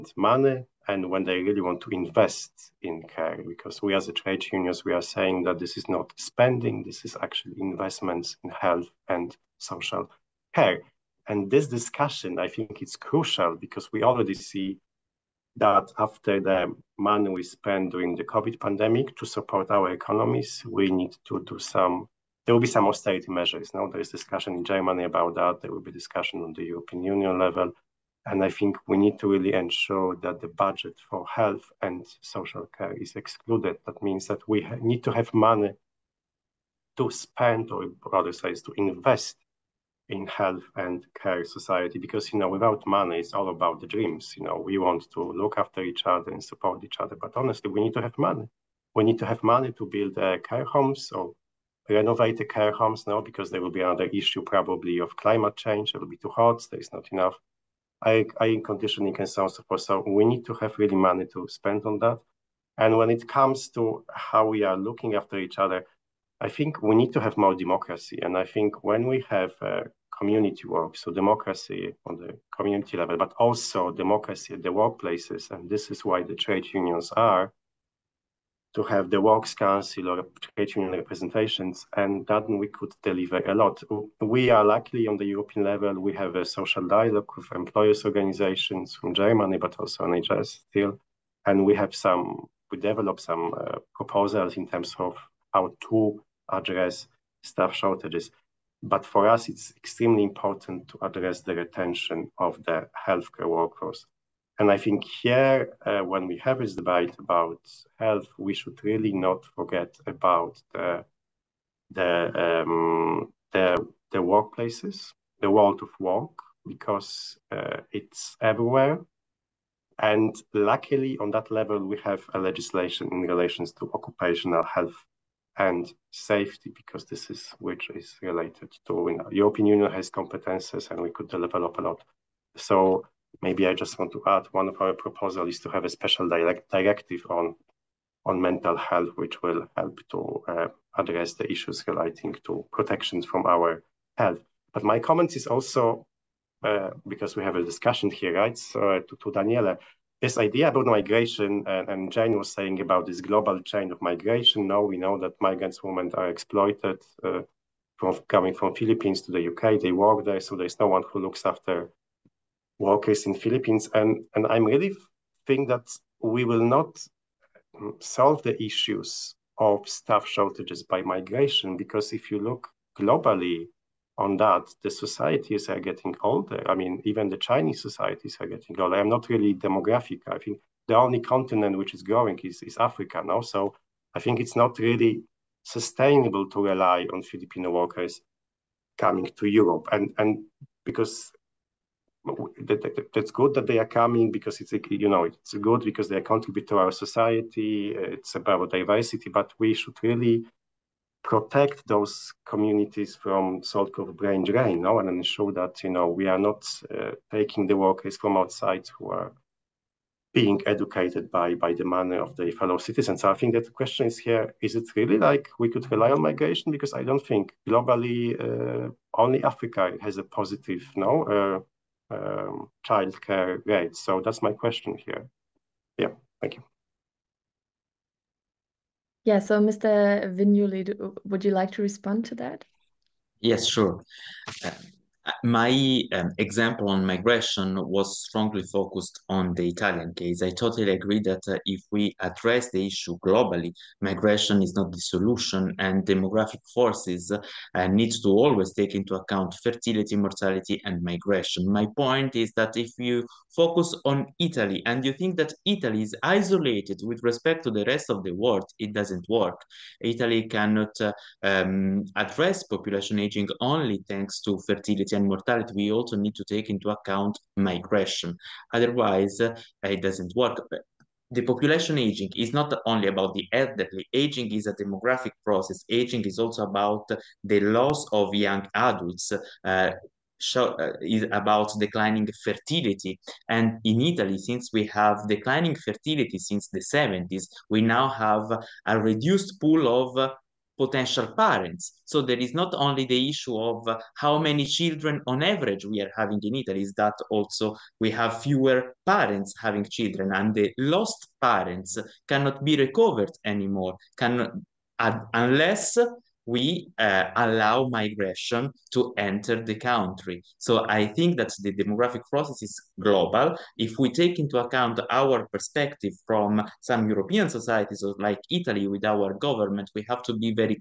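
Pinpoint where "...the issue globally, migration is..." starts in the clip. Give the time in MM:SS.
04:02.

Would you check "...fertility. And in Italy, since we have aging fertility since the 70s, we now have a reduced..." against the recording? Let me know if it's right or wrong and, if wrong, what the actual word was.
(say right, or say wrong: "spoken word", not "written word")
wrong: "declining", not "aging".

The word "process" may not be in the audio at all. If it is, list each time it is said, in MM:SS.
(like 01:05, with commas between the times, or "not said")
04:35, 05:12.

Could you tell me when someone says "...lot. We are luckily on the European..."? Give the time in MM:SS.
01:23.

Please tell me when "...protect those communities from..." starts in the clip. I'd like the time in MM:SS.
03:21.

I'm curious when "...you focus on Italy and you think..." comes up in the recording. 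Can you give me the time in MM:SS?
04:12.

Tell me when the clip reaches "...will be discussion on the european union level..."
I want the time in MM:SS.
00:25.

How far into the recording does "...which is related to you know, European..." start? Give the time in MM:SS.
02:07.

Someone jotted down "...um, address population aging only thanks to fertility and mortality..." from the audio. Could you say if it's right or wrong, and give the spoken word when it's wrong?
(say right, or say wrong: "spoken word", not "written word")
right.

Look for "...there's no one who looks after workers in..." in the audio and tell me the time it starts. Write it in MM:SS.
02:40.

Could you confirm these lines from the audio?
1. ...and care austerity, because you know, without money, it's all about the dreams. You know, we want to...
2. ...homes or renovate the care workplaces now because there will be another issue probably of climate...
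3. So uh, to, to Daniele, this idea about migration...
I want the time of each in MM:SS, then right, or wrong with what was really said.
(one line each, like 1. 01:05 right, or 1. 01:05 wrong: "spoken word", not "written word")
1. 00:40 wrong: "society", not "austerity"
2. 00:50 wrong: "homes", not "workplaces"
3. 02:28 right.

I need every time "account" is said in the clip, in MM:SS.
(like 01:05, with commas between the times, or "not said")
04:09, 04:26, 05:14.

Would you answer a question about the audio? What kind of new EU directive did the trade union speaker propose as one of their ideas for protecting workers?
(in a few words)
Mental health.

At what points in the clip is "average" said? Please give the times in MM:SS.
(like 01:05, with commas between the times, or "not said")
04:55.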